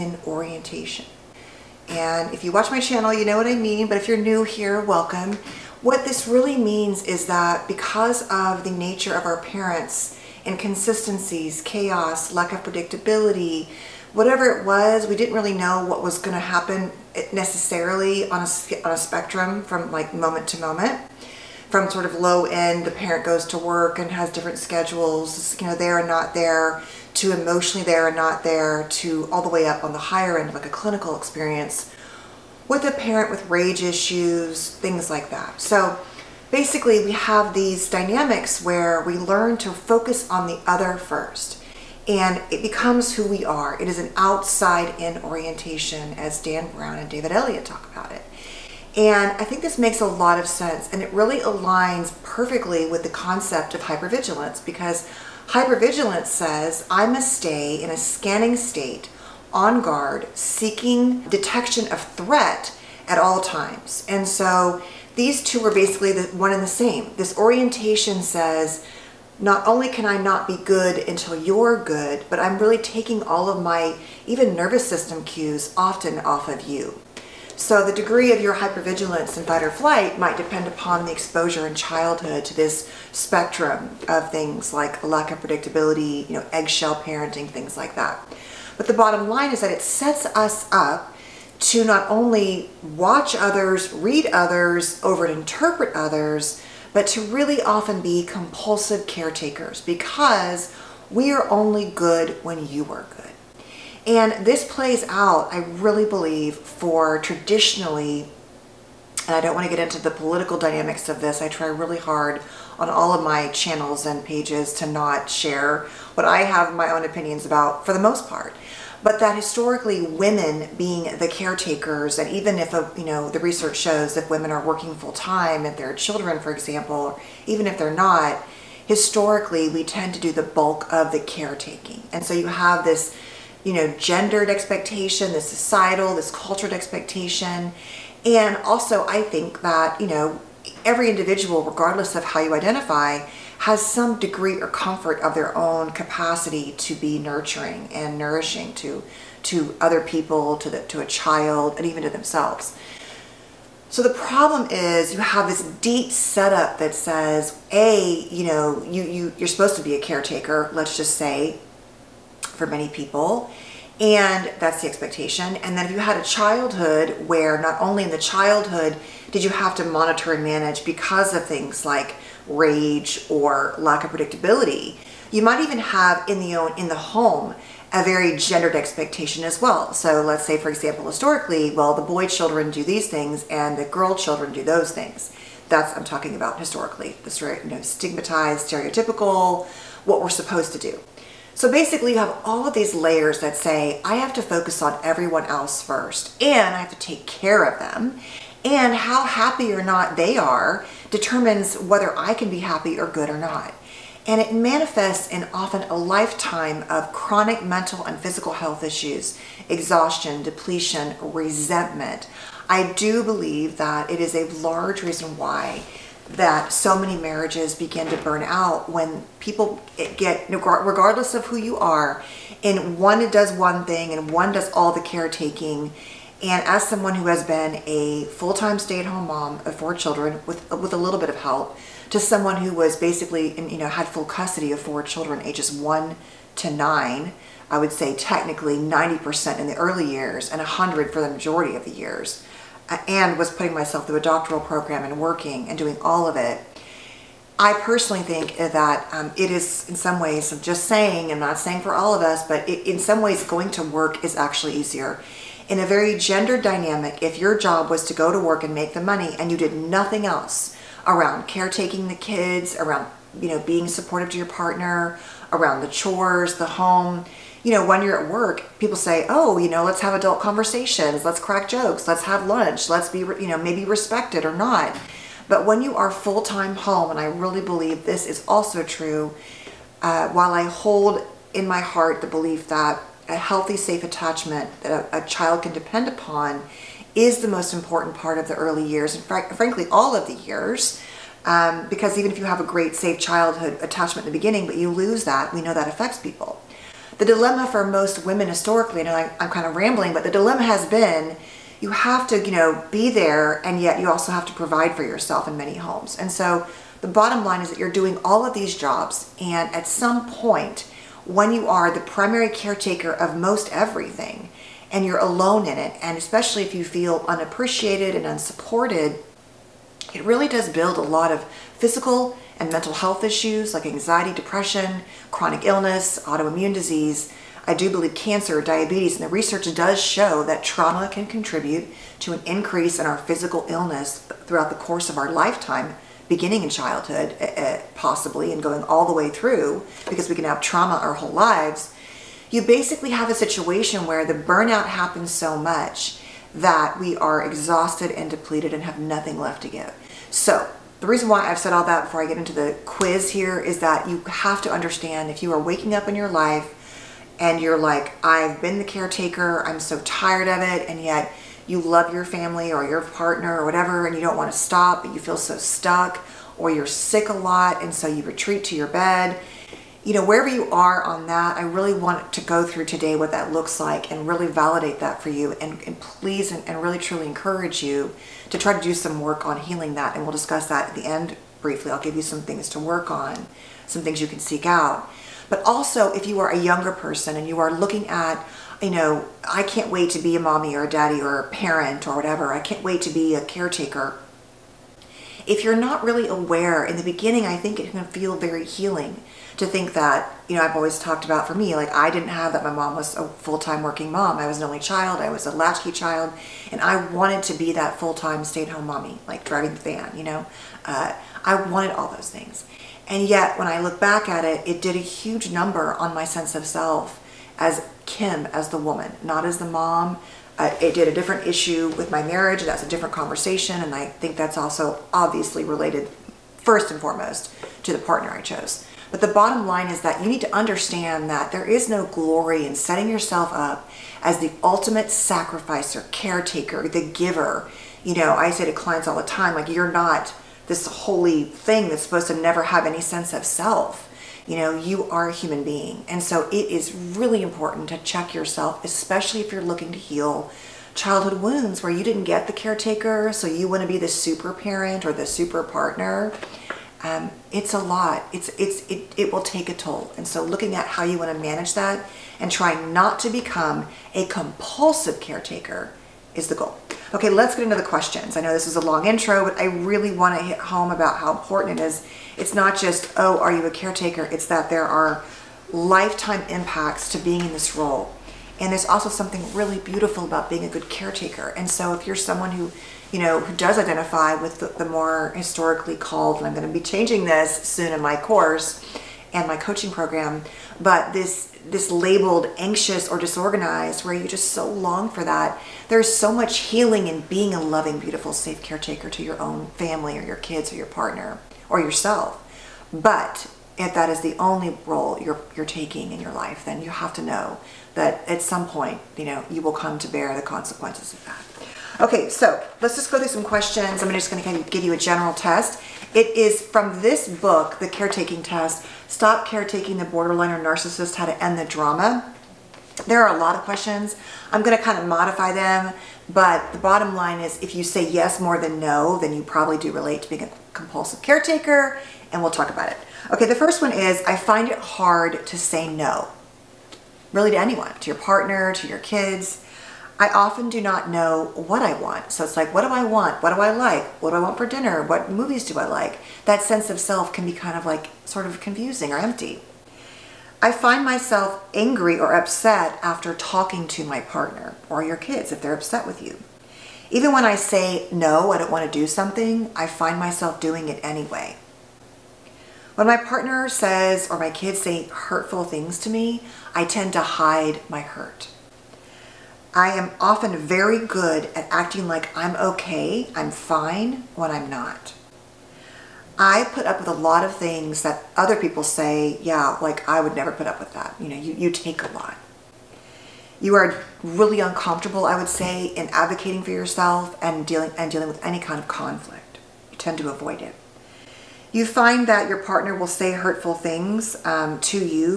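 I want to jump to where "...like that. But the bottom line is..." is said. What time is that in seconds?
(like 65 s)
87 s.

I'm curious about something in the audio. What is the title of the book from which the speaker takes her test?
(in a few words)
The Caretaking Test.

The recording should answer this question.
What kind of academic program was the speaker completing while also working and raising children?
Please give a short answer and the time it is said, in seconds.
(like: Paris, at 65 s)
doctoral program, at 244 s.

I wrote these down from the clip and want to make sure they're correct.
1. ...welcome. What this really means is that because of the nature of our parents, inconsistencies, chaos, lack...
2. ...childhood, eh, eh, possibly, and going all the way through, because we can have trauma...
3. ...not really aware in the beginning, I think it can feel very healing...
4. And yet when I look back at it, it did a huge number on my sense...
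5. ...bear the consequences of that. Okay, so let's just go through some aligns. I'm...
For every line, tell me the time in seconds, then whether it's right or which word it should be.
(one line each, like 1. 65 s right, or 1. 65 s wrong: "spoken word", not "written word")
1. 4 s right
2. 336 s right
3. 395 s right
4. 413 s right
5. 510 s wrong: "questions", not "aligns".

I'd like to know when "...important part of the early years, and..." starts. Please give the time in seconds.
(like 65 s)
287 s.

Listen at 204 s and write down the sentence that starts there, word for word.
And it manifests in often a lifetime of chronic mental and physical health issues, exhaustion, depletion, resentment.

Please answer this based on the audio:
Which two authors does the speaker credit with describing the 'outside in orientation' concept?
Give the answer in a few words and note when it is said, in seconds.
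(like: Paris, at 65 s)
Dan Brown and David Elliott, at 46 s.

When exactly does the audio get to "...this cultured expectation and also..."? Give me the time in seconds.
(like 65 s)
136 s.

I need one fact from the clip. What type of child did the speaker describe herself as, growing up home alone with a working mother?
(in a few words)
latchkey child.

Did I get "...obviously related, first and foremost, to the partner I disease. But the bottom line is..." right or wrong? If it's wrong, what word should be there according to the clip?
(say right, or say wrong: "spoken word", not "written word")
wrong: "chose", not "disease".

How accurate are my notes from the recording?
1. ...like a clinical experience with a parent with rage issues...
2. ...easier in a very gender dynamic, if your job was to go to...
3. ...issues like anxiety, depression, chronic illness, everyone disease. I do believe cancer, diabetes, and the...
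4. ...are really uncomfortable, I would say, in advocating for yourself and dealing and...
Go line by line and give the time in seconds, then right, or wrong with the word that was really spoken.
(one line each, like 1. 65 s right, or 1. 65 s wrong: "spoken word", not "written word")
1. 30 s right
2. 254 s right
3. 323 s wrong: "autoimmune", not "everyone"
4. 583 s right.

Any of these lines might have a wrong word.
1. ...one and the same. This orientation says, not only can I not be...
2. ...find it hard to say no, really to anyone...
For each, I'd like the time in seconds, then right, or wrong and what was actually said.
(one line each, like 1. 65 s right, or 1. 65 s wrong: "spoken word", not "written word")
1. 66 s right
2. 534 s right.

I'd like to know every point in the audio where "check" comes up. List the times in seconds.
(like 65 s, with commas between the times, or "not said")
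447 s.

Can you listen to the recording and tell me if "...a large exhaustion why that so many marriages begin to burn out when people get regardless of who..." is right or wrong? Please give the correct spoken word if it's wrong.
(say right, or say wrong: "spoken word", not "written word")
wrong: "reason", not "exhaustion".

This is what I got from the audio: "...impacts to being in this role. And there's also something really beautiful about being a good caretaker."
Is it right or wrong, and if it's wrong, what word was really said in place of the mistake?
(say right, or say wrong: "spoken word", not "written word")
right.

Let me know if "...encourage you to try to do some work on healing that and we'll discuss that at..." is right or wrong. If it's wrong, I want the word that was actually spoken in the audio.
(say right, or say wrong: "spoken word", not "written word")
right.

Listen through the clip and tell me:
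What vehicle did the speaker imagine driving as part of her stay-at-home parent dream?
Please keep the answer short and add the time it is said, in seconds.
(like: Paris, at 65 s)
the van, at 409 s.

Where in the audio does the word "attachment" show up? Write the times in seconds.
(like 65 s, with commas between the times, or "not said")
284 s, 293 s.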